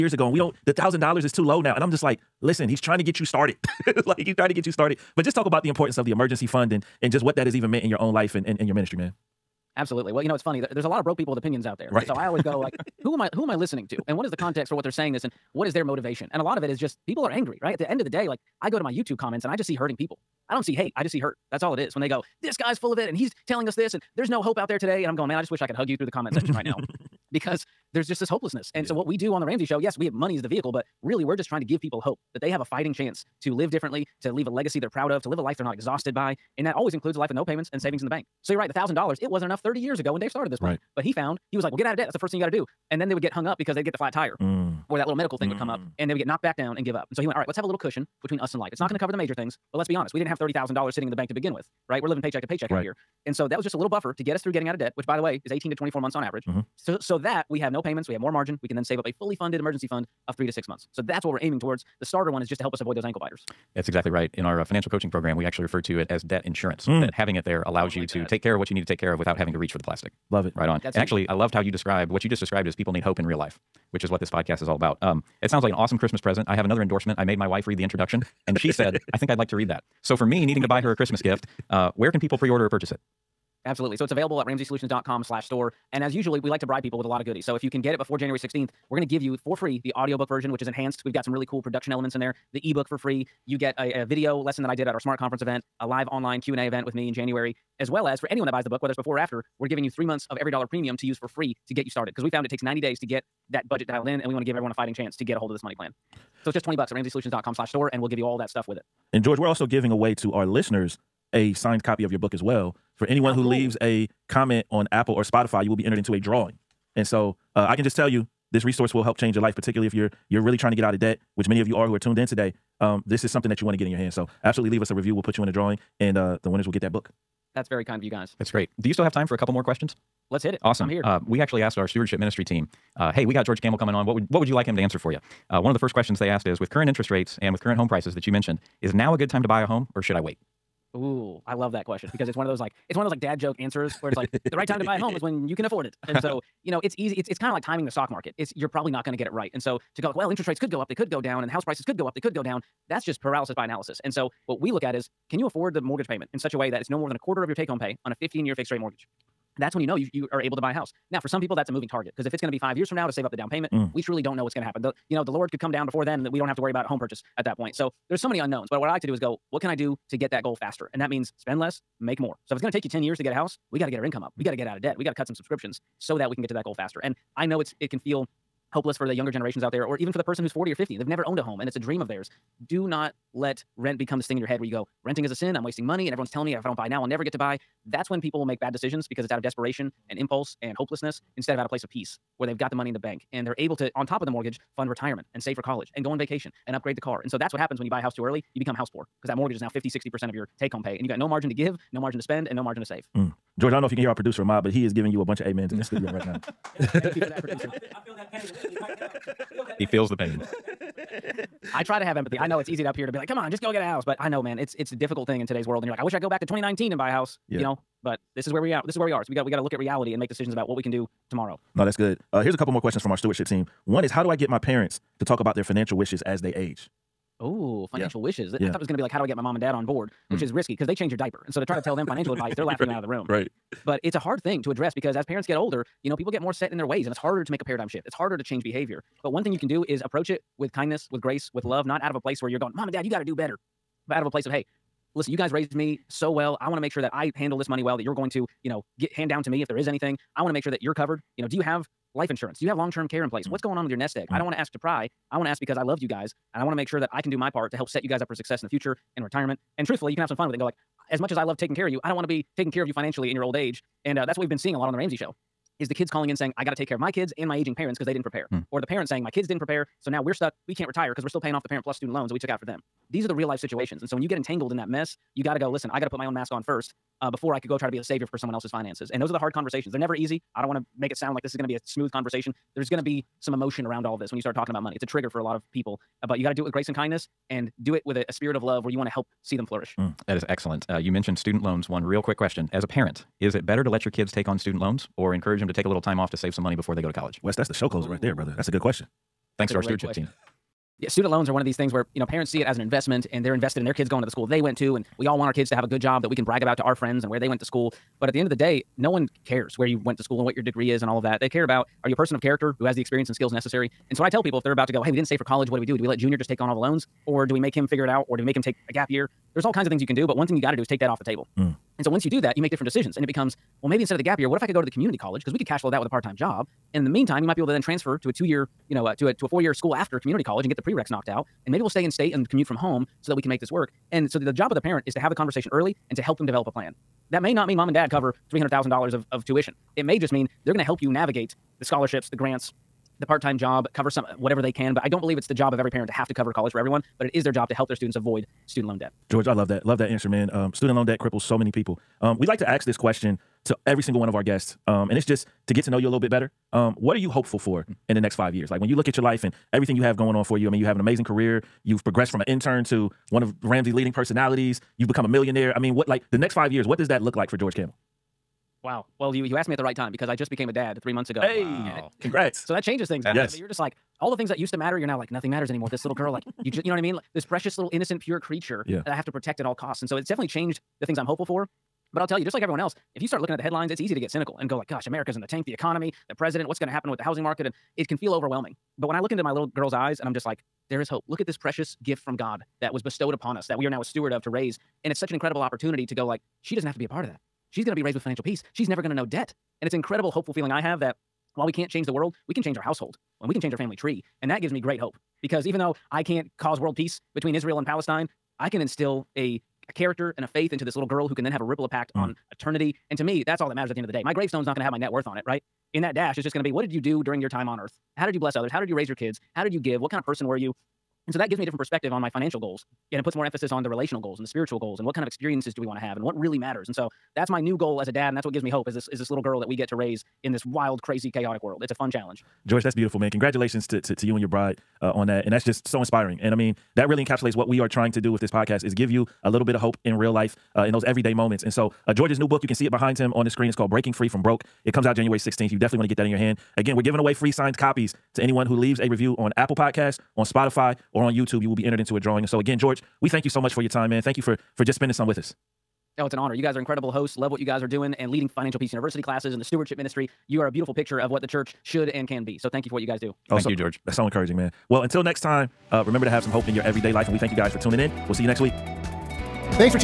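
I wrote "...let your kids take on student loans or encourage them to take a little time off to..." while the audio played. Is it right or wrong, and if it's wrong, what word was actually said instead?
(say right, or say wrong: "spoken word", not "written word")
right.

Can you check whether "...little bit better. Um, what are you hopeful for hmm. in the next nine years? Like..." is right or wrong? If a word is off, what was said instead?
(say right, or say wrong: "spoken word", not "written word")
wrong: "five", not "nine".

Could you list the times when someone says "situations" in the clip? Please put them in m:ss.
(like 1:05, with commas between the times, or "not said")
4:33.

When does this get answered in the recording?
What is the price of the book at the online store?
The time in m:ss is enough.
1:46.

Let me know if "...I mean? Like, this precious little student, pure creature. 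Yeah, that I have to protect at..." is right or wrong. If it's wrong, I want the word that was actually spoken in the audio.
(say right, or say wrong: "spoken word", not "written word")
wrong: "innocent", not "student".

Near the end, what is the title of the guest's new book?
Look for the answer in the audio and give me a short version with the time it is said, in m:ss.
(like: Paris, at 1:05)
Breaking Free from Broke, at 7:23.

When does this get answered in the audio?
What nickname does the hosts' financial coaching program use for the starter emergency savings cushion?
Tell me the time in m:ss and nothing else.
1:06.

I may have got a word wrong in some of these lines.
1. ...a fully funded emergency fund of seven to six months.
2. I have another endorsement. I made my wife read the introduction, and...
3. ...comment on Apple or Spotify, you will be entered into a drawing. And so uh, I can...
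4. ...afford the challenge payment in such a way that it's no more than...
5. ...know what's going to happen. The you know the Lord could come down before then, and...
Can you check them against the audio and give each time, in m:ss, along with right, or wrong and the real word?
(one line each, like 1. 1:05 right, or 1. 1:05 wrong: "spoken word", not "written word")
1. 0:59 wrong: "three", not "seven"
2. 1:16 right
3. 1:54 right
4. 2:35 wrong: "mortgage", not "challenge"
5. 2:44 right.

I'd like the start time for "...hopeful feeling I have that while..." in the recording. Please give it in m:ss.
6:40.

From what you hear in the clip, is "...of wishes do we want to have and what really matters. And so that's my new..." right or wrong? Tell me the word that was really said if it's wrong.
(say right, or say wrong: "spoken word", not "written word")
wrong: "experiences", not "wishes".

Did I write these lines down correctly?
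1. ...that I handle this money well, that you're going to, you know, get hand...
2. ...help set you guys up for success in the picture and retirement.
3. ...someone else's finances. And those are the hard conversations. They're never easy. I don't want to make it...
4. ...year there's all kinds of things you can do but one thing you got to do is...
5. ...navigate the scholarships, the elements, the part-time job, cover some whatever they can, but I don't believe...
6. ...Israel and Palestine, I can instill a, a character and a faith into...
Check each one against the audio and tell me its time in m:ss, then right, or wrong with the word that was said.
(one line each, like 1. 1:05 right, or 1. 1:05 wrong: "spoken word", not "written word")
1. 4:07 right
2. 4:17 wrong: "future", not "picture"
3. 4:38 right
4. 5:19 right
5. 5:41 wrong: "grants", not "elements"
6. 6:47 right.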